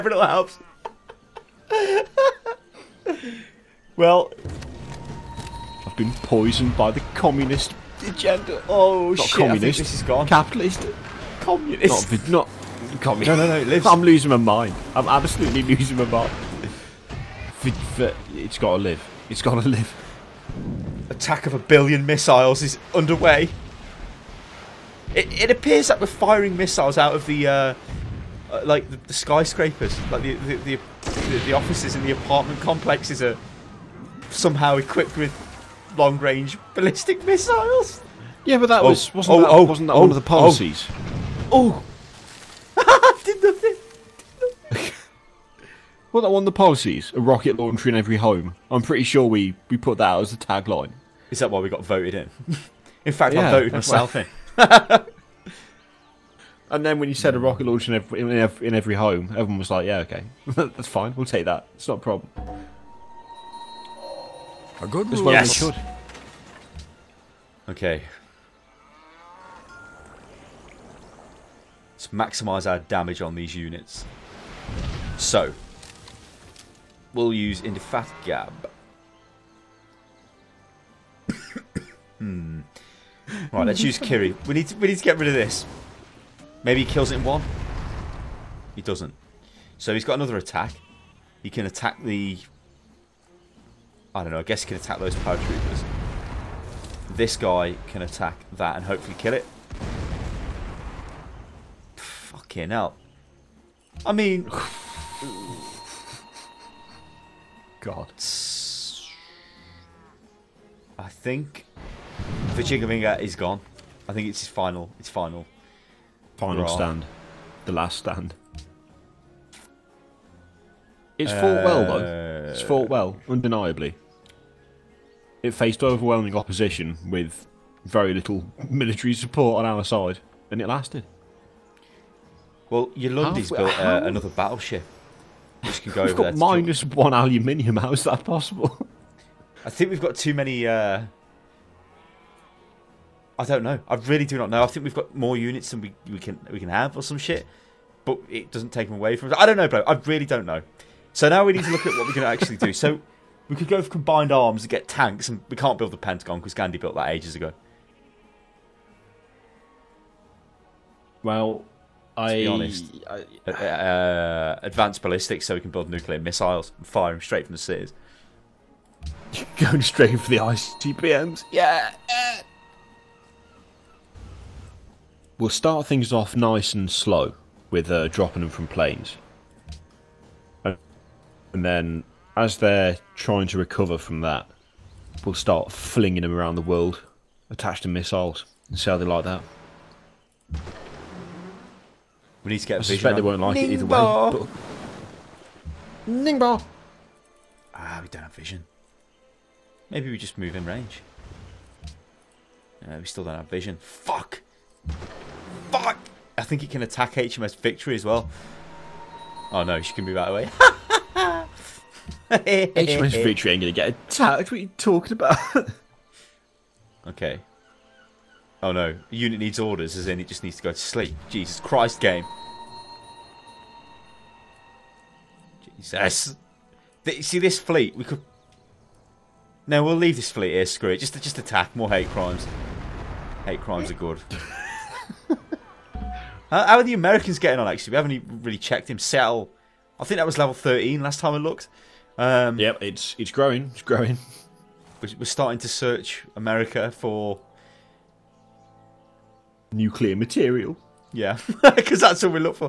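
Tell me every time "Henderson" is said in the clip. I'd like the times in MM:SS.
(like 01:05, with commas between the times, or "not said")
not said.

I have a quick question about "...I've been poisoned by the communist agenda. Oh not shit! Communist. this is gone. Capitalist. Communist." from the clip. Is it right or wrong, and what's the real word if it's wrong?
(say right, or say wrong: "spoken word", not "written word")
right.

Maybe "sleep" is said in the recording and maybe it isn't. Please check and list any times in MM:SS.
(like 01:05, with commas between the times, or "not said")
03:40.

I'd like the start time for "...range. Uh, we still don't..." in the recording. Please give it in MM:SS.
03:20.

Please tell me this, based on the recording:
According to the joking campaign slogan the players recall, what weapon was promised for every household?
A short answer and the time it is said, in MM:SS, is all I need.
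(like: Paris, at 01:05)
a rocket launcher, at 00:47.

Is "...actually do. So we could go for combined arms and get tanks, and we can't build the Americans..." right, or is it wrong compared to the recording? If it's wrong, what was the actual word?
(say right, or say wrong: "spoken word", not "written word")
wrong: "Pentagon", not "Americans".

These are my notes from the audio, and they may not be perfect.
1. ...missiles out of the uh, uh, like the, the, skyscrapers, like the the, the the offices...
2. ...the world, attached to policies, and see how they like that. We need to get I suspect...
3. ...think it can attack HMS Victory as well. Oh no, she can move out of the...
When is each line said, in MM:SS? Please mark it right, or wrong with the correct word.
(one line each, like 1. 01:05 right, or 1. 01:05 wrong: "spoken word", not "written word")
1. 00:26 right
2. 03:06 wrong: "missiles", not "policies"
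3. 03:26 right.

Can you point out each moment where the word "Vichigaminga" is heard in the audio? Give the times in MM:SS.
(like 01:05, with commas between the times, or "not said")
01:52.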